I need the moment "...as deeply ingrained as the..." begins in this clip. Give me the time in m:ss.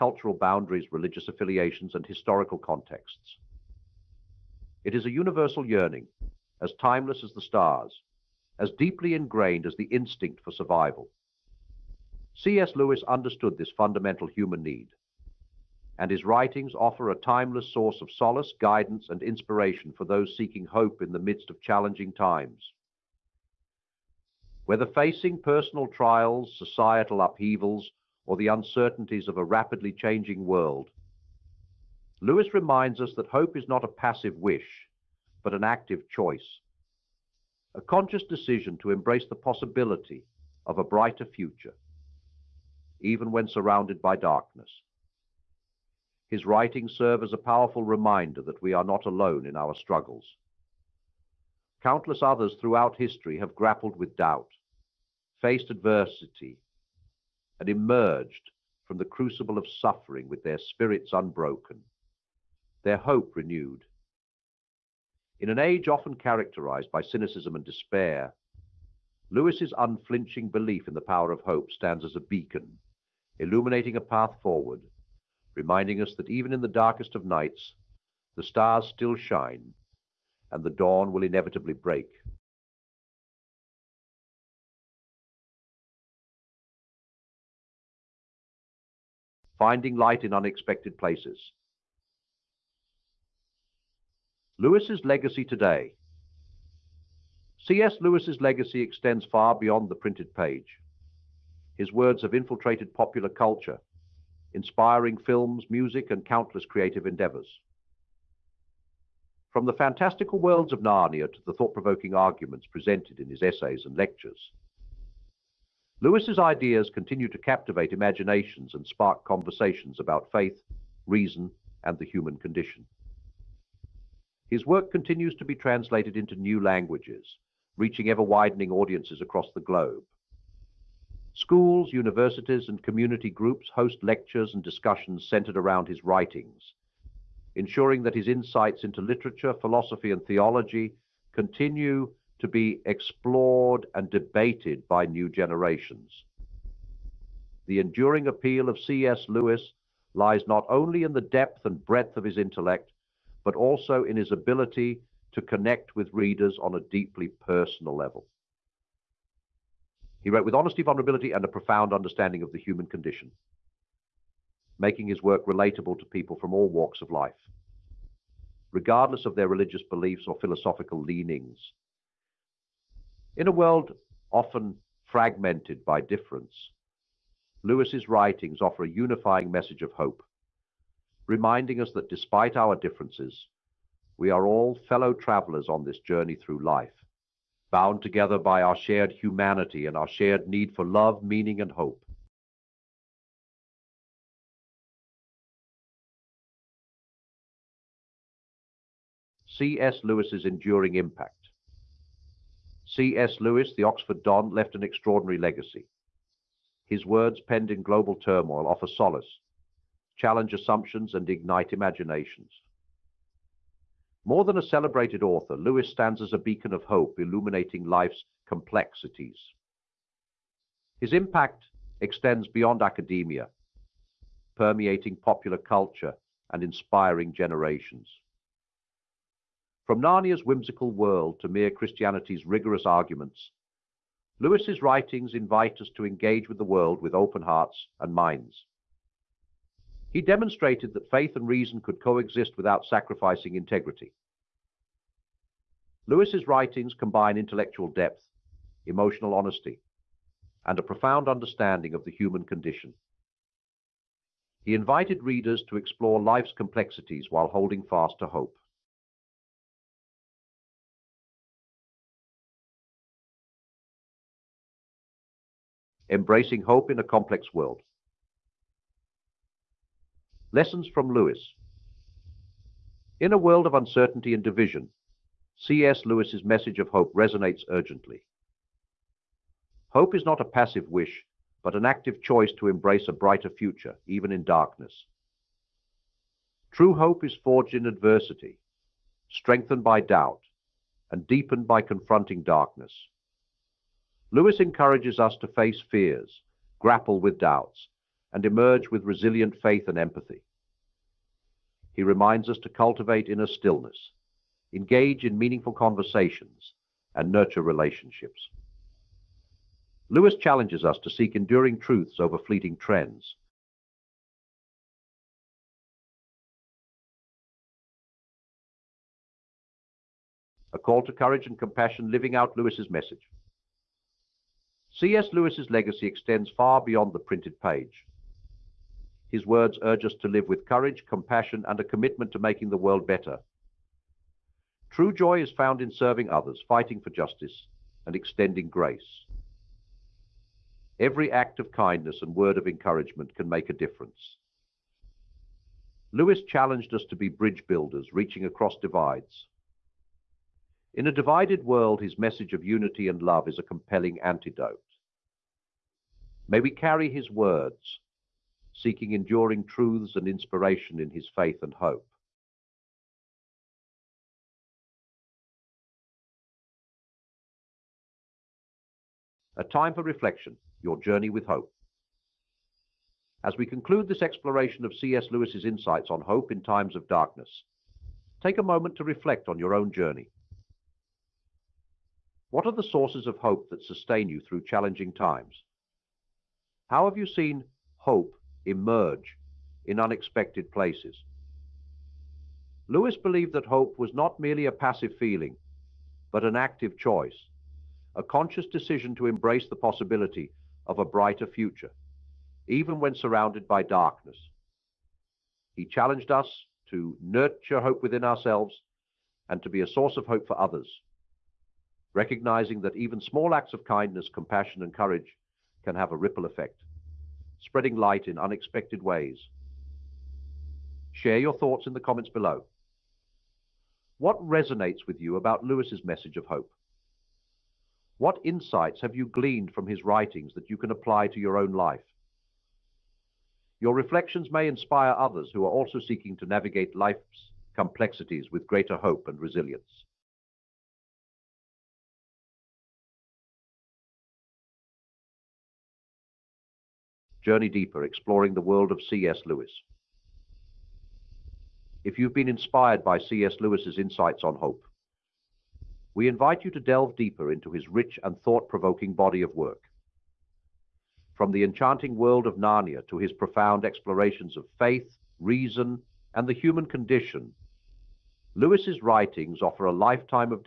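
0:08.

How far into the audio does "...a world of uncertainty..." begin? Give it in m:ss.
4:33.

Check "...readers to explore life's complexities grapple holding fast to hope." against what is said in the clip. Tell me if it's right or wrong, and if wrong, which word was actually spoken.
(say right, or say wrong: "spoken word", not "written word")
wrong: "while", not "grapple".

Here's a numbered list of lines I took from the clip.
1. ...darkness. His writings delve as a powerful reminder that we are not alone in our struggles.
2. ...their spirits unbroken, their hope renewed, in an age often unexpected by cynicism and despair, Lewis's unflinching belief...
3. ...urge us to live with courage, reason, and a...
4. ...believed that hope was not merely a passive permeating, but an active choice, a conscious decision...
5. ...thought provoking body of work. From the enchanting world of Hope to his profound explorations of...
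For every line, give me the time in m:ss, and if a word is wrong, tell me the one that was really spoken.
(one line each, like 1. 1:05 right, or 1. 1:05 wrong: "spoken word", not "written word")
1. 0:44 wrong: "serve", not "delve"
2. 1:00 wrong: "characterized", not "unexpected"
3. 5:29 wrong: "compassion", not "reason"
4. 6:33 wrong: "feeling", not "permeating"
5. 7:38 wrong: "Narnia", not "Hope".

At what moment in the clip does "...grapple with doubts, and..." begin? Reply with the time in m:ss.
4:56.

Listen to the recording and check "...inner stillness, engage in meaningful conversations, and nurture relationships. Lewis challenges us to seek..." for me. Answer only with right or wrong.
right.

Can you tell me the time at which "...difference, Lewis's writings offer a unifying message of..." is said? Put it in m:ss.
2:56.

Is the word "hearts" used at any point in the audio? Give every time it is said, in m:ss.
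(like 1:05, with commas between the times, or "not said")
3:57.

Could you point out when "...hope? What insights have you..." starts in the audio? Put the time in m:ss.
7:06.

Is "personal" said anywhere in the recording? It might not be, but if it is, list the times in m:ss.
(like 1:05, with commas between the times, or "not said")
0:25, 2:37.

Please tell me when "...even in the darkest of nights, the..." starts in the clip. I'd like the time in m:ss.
1:16.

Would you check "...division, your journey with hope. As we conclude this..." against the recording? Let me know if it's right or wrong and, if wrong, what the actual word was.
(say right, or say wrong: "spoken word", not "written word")
wrong: "reflection", not "division".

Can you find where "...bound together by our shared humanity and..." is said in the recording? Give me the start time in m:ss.
3:07.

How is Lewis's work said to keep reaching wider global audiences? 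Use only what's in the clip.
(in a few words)
New languages.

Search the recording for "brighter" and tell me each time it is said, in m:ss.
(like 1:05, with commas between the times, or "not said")
0:40, 4:43, 6:41.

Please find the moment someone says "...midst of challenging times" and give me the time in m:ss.
0:21.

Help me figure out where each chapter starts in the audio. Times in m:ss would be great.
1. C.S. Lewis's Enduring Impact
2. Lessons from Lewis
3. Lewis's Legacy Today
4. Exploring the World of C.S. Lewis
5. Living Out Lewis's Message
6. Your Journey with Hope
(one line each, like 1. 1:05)
1. 3:12
2. 4:18
3. 1:22
4. 7:20
5. 5:13
6. 6:02.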